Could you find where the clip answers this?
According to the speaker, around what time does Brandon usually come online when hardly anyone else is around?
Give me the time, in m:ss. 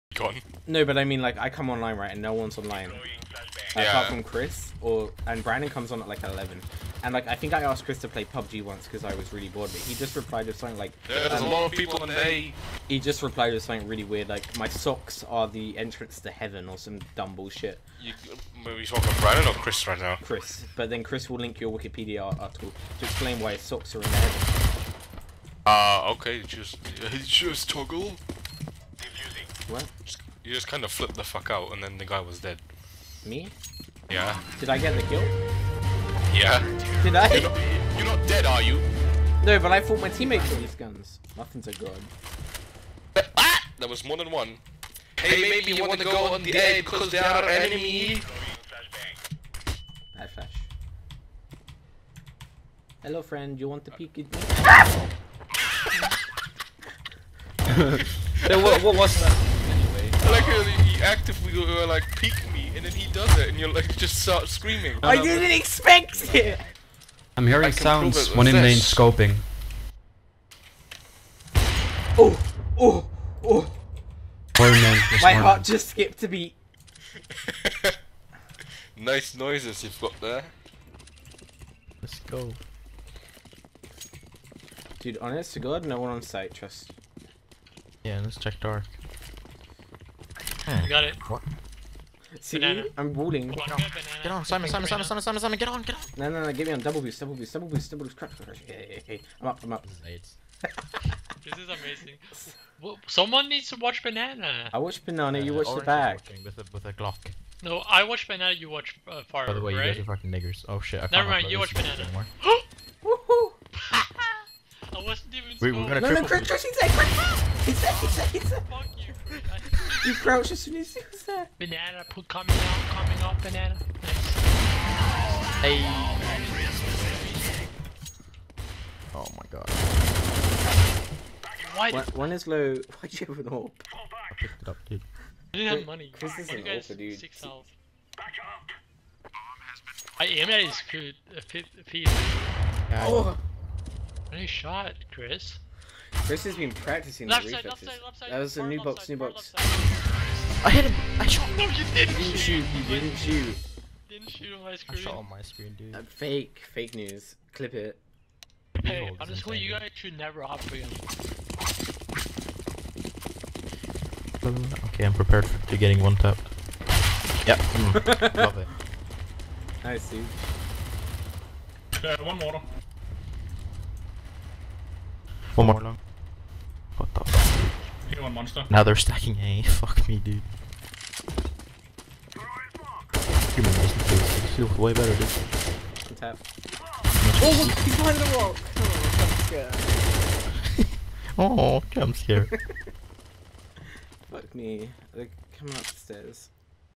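0:06.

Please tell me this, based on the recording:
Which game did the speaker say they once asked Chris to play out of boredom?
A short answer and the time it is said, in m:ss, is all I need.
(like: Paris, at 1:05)
PUBG, at 0:08.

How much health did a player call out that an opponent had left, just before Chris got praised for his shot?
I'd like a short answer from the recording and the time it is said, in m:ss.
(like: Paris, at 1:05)
6, at 2:17.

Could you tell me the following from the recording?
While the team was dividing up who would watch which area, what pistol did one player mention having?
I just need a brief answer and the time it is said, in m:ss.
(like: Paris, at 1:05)
Glock, at 1:46.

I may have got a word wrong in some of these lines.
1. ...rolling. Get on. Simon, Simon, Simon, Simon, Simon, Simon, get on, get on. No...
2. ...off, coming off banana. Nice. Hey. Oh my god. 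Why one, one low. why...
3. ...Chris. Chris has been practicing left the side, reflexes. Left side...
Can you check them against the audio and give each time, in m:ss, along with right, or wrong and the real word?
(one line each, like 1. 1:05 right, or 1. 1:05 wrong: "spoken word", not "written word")
1. 1:33 right
2. 2:02 right
3. 2:25 right.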